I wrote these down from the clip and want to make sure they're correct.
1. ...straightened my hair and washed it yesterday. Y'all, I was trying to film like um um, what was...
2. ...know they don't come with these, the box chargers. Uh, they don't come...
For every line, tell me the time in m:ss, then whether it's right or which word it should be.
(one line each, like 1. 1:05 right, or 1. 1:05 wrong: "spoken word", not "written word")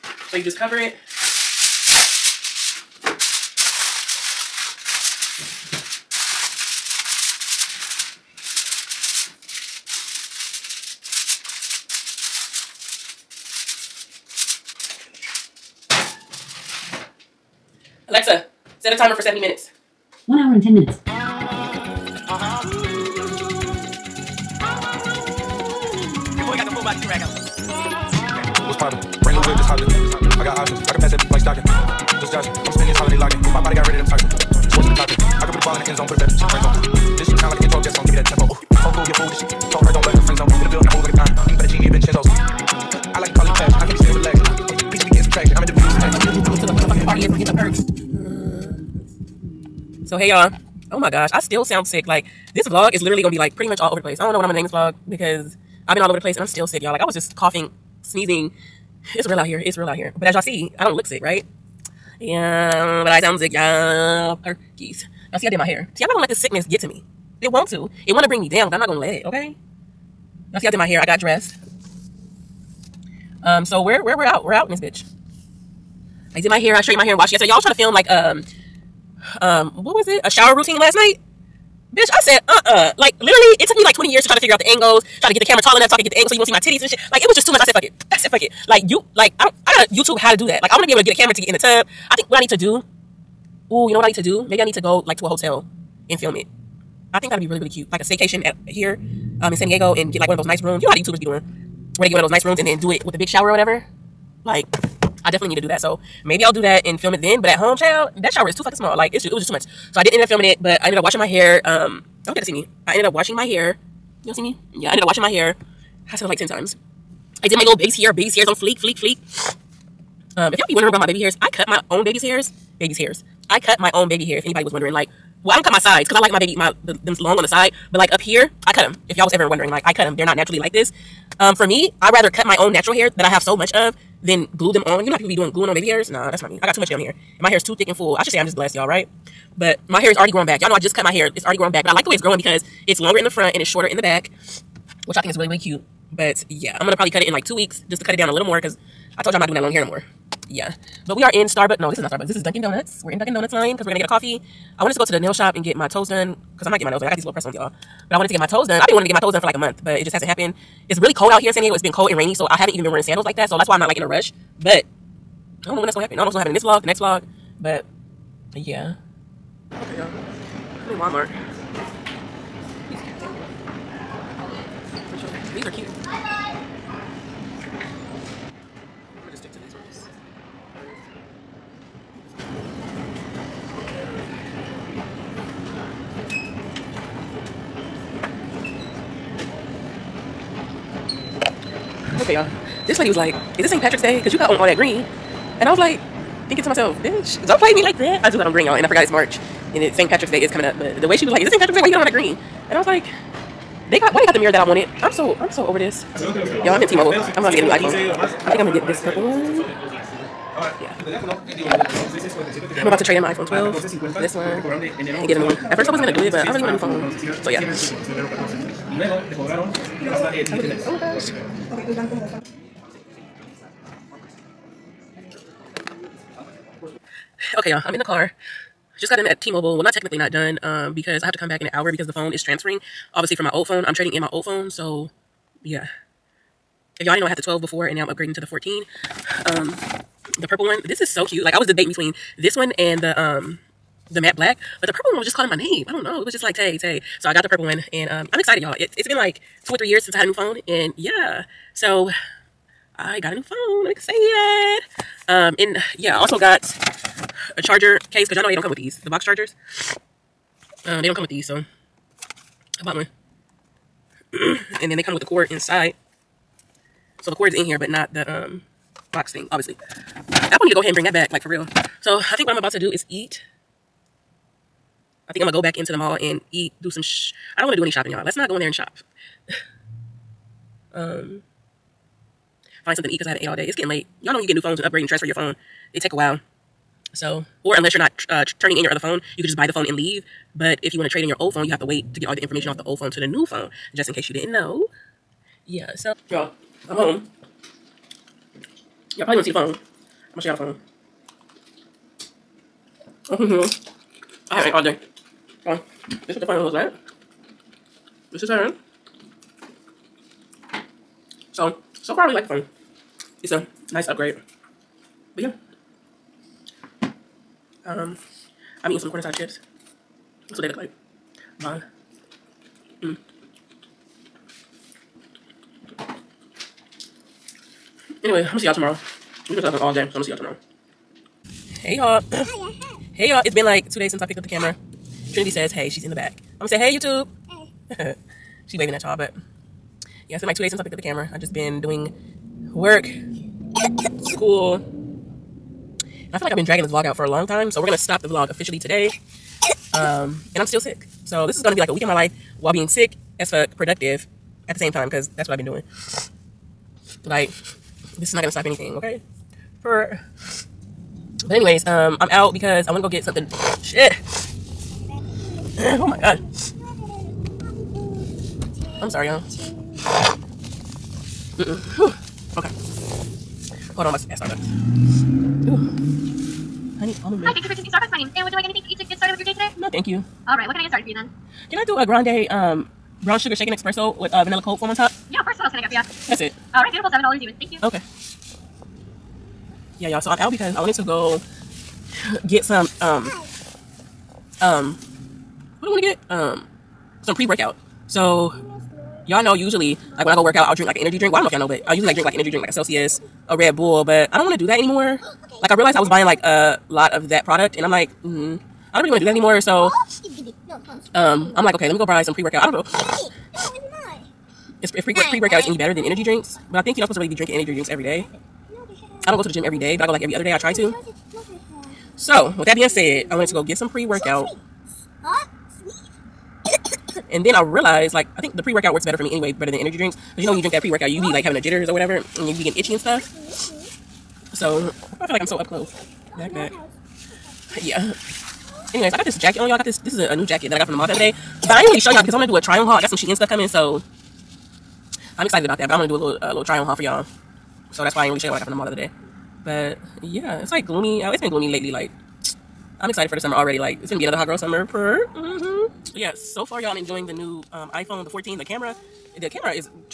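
1. 1:16 right
2. 4:18 right.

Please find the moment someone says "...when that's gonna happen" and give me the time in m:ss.
2:45.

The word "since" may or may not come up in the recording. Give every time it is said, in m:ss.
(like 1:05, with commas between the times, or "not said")
4:10, 5:34, 5:40.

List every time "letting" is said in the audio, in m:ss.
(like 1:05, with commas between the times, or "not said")
not said.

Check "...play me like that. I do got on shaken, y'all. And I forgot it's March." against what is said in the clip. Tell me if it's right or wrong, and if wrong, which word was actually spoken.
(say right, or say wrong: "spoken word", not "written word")
wrong: "green", not "shaken".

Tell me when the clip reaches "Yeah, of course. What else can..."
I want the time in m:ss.
6:25.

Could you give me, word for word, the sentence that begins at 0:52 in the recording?
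Like this vlog is literally gonna be like pretty much all over the place.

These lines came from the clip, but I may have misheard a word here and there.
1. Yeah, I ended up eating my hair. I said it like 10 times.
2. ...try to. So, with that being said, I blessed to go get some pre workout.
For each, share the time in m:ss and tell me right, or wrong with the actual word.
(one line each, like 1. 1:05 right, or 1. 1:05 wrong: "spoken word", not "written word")
1. 1:54 wrong: "washing", not "eating"
2. 7:00 wrong: "wanted", not "blessed".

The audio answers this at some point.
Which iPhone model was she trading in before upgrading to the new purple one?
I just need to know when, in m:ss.
3:33.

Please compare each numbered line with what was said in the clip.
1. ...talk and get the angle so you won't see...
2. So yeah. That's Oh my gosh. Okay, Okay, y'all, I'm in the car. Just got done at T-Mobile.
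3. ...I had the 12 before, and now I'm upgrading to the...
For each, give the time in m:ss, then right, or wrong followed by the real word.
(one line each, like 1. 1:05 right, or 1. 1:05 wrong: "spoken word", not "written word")
1. 1:25 right
2. 3:37 right
3. 3:57 right.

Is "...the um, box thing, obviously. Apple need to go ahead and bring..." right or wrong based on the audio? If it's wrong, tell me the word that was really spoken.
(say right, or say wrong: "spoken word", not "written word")
right.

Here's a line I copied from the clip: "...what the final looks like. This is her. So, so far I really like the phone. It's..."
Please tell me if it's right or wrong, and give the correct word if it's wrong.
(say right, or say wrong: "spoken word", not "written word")
right.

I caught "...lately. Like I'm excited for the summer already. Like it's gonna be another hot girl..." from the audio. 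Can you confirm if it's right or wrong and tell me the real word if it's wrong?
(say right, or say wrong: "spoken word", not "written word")
right.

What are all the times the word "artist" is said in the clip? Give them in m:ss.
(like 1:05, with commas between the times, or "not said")
not said.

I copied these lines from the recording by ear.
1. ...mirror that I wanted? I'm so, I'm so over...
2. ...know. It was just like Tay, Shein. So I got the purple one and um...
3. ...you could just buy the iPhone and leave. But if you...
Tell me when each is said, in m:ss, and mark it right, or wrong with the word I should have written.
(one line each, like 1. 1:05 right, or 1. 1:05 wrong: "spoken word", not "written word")
1. 3:24 right
2. 4:06 wrong: "Tay", not "Shein"
3. 4:49 wrong: "phone", not "iPhone".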